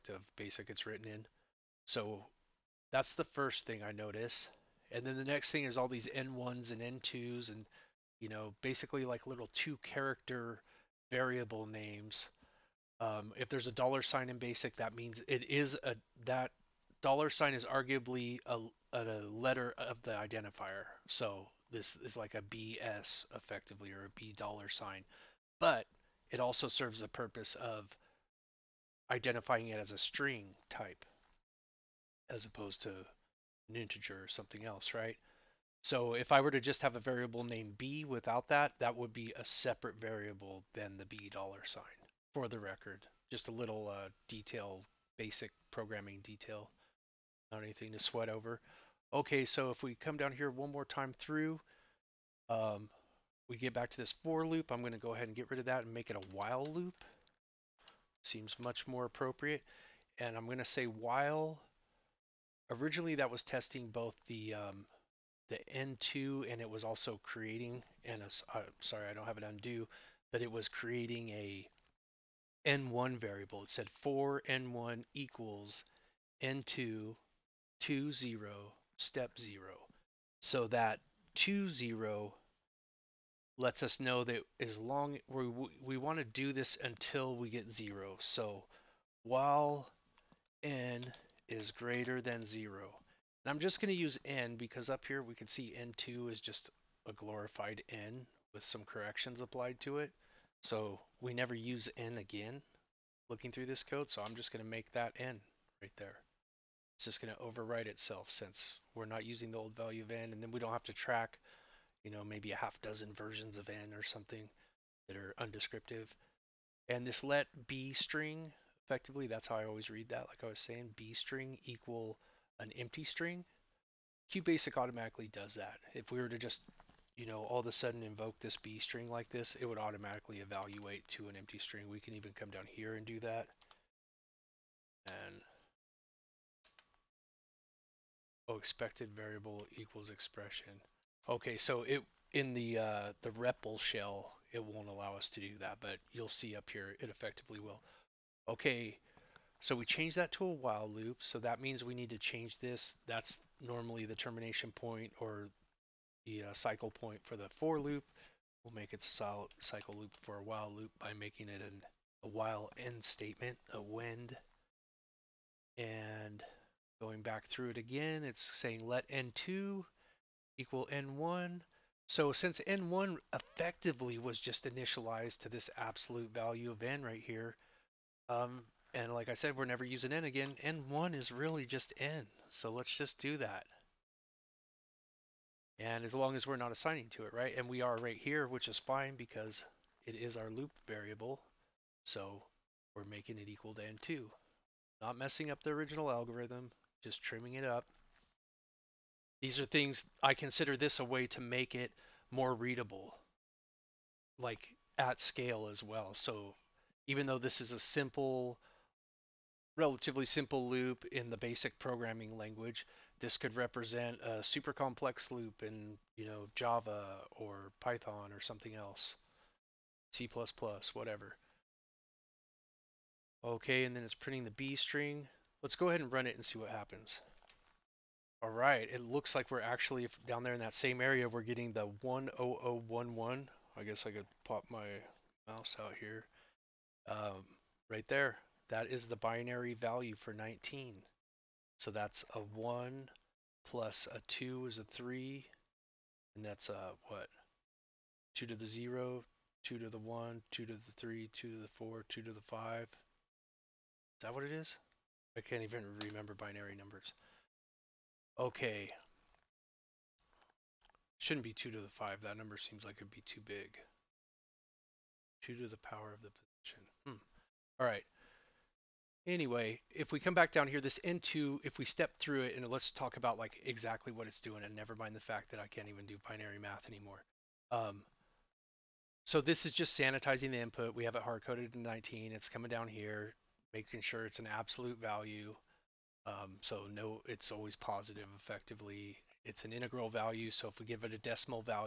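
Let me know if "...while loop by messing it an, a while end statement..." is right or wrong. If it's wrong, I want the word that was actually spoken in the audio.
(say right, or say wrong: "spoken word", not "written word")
wrong: "making", not "messing".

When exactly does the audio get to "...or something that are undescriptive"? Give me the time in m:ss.
1:53.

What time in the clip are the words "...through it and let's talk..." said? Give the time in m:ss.
4:32.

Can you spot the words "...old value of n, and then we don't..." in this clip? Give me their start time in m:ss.
1:49.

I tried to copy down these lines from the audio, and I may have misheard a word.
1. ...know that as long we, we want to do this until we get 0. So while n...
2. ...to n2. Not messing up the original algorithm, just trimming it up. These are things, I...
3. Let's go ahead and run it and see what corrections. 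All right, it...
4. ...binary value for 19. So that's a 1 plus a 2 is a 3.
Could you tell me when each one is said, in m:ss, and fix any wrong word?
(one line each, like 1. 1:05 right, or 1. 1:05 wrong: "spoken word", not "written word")
1. 1:23 right
2. 3:13 right
3. 3:45 wrong: "happens", not "corrections"
4. 3:59 right.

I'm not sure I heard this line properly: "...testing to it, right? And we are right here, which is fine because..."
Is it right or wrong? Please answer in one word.
wrong.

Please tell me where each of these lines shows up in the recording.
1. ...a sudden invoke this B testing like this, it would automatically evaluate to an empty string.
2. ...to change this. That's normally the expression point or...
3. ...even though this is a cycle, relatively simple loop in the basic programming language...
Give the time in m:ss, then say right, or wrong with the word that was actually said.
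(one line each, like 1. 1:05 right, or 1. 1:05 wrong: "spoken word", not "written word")
1. 2:07 wrong: "string", not "testing"
2. 2:32 wrong: "termination", not "expression"
3. 3:27 wrong: "simple", not "cycle".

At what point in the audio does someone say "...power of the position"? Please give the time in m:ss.
4:25.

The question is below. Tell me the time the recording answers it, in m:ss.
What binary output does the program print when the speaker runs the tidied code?
3:52.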